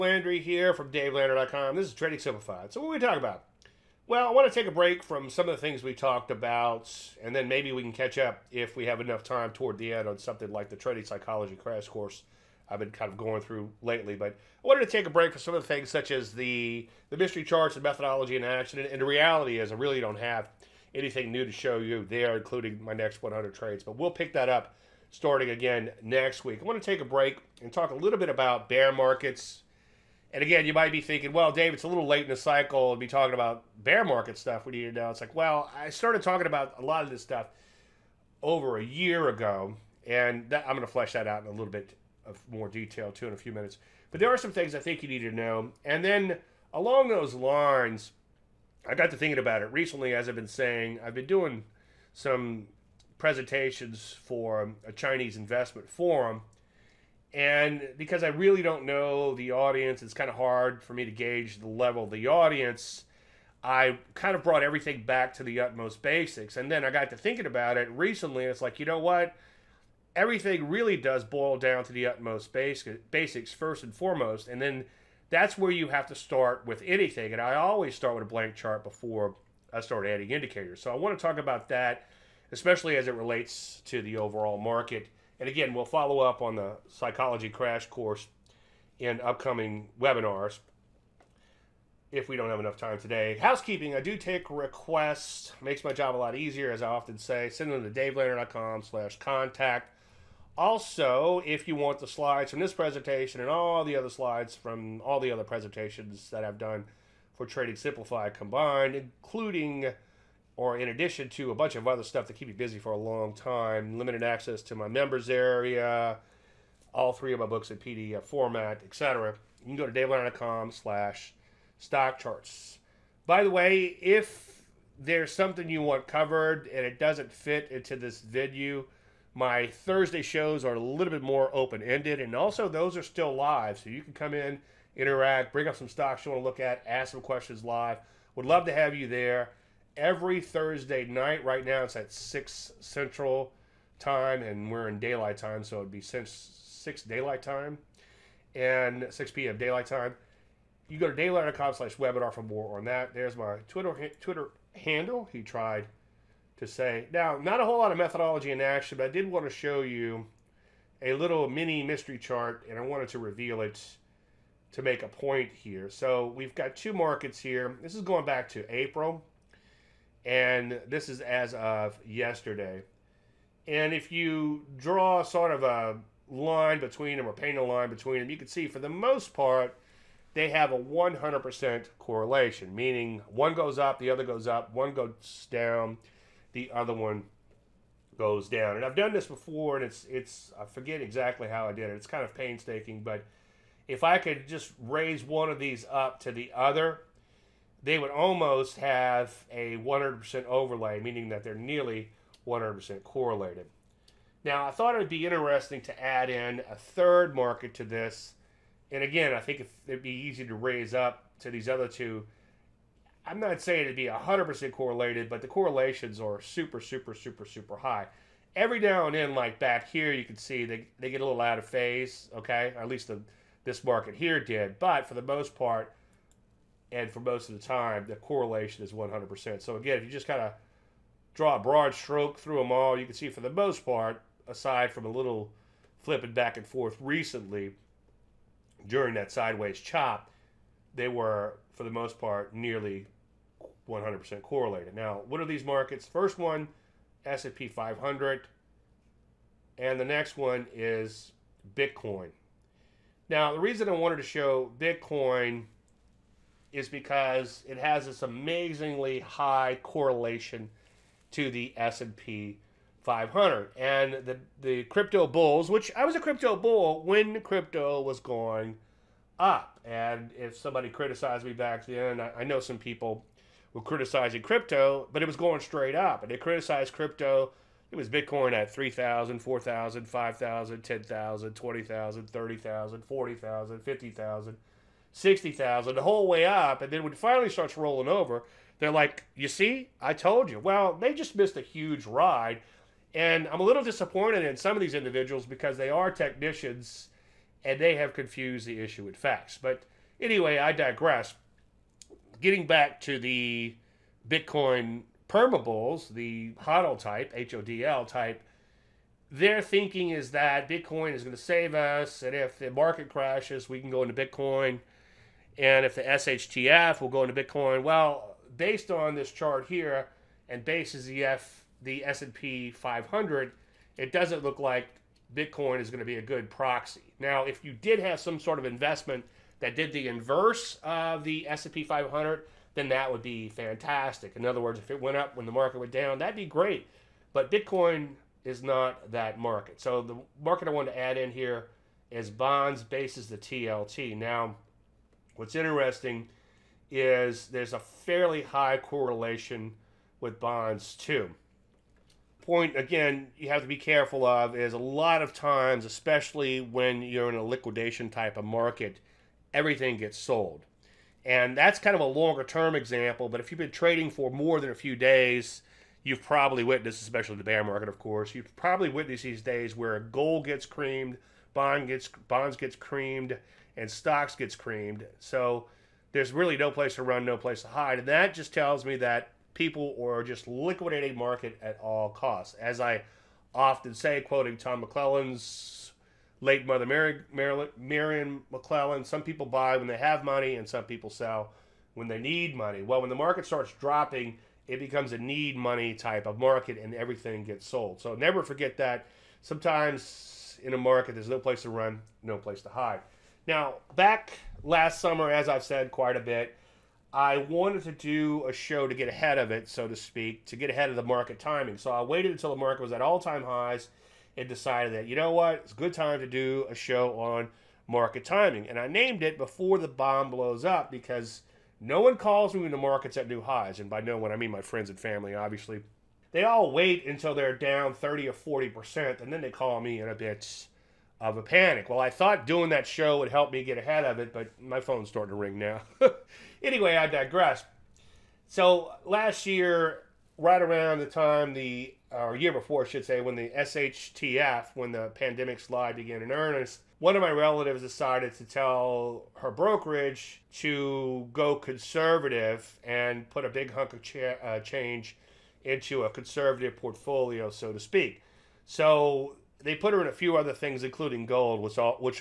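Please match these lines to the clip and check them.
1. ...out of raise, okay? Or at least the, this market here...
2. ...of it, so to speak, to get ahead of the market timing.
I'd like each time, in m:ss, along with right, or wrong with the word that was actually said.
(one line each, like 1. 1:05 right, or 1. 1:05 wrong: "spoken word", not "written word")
1. 3:41 wrong: "phase", not "raise"
2. 6:49 right.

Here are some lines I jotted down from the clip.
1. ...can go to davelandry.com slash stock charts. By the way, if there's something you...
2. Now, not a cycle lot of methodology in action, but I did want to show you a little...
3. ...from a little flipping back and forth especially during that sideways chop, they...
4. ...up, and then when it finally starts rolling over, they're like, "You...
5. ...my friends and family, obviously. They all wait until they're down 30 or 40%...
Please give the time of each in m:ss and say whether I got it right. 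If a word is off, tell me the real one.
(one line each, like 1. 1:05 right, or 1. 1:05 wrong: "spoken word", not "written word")
1. 1:59 right
2. 2:37 wrong: "whole", not "cycle"
3. 3:54 wrong: "recently", not "especially"
4. 4:46 right
5. 7:04 right.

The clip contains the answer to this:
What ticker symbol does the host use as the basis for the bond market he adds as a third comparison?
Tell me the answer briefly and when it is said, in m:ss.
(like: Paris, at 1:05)
TLT, at 5:43.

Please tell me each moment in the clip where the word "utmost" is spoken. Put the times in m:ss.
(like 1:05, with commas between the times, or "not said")
1:05, 1:12.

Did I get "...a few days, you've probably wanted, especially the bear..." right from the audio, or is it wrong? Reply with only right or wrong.
wrong.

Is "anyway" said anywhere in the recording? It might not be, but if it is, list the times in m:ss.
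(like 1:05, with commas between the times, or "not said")
5:00, 7:16.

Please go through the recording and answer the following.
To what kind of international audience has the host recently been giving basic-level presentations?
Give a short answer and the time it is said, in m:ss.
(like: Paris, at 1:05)
Chinese investment forum, at 0:54.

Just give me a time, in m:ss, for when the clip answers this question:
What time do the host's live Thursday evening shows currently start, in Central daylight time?
2:29.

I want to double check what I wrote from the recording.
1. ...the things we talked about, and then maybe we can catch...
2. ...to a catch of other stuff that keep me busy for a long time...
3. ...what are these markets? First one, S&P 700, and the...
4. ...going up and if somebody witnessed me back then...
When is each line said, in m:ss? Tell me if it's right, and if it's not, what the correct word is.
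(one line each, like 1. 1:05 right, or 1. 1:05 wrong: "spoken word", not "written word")
1. 0:05 right
2. 1:51 wrong: "bunch", not "catch"
3. 4:05 wrong: "500", not "700"
4. 4:28 wrong: "criticized", not "witnessed".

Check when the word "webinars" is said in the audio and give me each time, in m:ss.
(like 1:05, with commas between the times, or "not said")
1:29, 2:31.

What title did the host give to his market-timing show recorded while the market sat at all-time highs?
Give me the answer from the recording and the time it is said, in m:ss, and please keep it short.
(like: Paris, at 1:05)
Before the Bomb Blows Up, at 6:59.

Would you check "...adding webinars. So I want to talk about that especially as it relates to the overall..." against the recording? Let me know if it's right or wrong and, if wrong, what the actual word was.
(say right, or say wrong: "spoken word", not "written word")
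wrong: "indicators", not "webinars".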